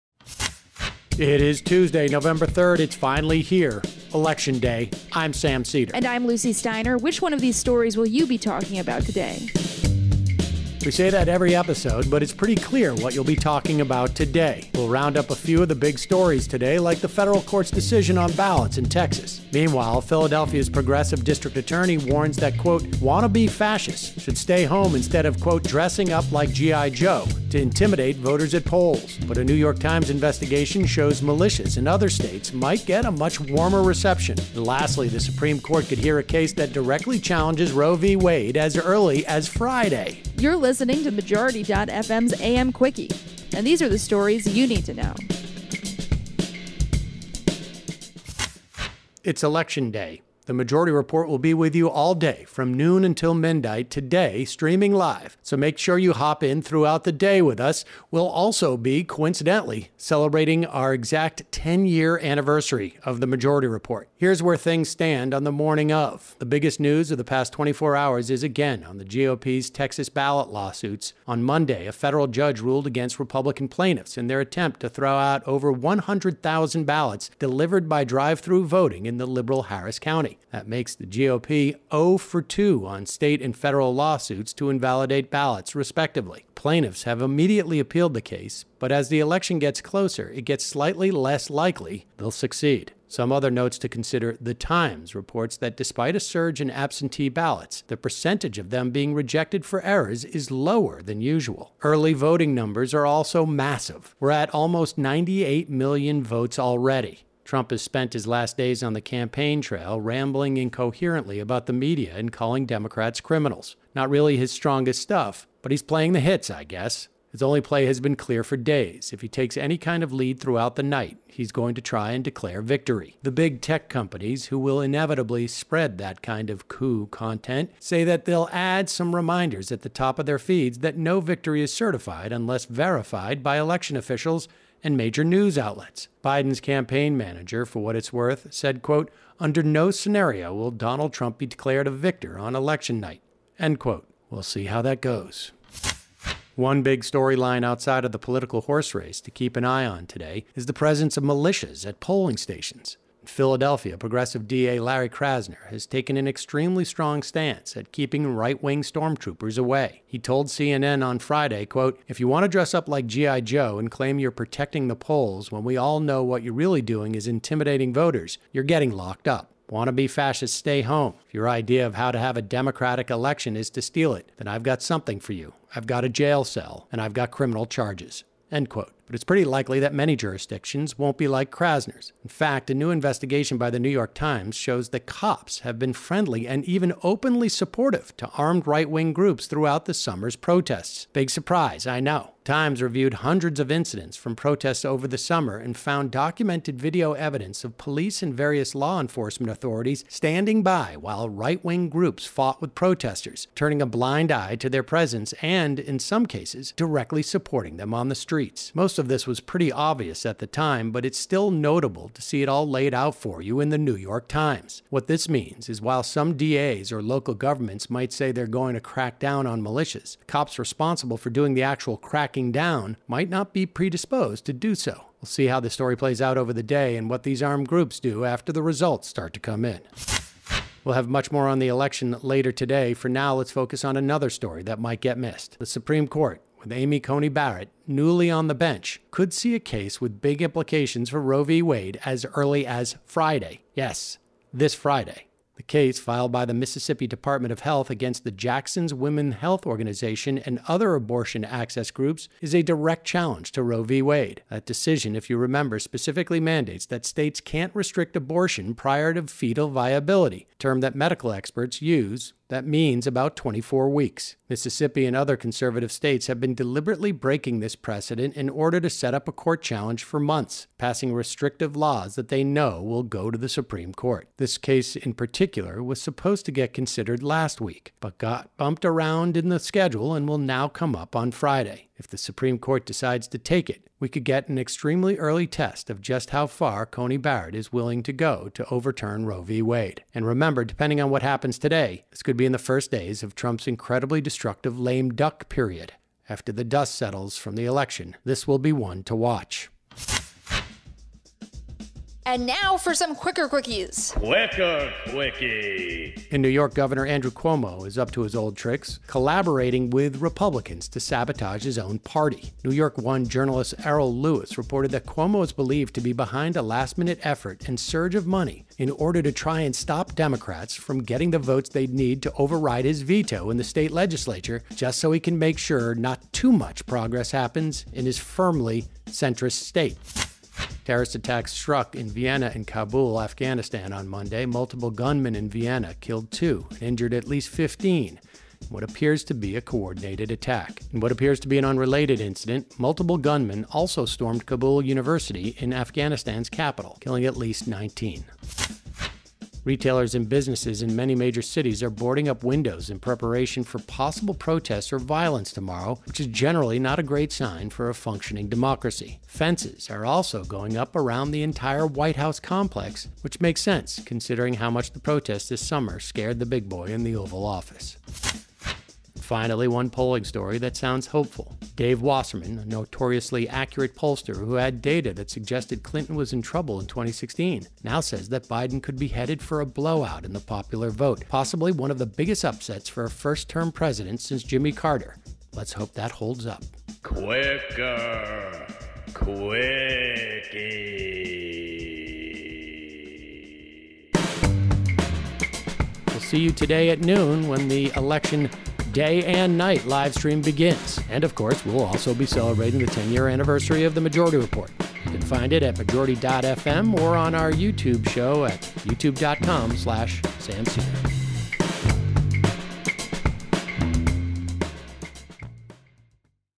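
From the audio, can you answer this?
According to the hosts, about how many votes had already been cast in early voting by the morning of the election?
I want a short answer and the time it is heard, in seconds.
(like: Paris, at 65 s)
almost 98 million, at 104 s.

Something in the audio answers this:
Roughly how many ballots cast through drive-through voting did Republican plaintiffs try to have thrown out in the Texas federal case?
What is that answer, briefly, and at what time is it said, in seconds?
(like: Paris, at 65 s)
over 100,000, at 75 s.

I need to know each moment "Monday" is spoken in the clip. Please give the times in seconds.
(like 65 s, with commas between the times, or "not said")
71 s, 334 s.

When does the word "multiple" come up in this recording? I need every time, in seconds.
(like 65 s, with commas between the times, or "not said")
334 s, 342 s.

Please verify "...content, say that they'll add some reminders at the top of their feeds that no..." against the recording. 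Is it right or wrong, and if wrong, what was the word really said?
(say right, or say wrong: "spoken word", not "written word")
right.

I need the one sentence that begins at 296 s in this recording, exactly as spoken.
After the dust settles from the election, this will be one to watch.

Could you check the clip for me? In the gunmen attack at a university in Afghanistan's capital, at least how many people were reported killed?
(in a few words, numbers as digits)
19.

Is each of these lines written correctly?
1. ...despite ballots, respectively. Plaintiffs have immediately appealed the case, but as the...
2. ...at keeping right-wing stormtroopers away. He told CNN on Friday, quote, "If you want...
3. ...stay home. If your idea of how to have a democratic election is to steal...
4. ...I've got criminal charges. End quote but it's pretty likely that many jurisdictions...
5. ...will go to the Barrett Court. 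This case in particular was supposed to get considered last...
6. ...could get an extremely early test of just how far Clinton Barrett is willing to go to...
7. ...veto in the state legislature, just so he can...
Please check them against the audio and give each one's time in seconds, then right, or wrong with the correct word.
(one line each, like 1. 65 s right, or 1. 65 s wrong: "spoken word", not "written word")
1. 84 s wrong: "invalidate", not "despite"
2. 157 s right
3. 170 s right
4. 176 s right
5. 272 s wrong: "Supreme", not "Barrett"
6. 284 s wrong: "Coney", not "Clinton"
7. 323 s right.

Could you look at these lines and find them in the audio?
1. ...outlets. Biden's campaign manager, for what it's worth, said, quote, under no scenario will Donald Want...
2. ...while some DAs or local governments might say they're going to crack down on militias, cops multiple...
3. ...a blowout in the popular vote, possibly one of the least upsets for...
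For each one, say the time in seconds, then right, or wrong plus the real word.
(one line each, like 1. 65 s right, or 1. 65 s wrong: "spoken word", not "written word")
1. 135 s wrong: "Trump", not "Want"
2. 215 s wrong: "responsible", not "multiple"
3. 379 s wrong: "biggest", not "least".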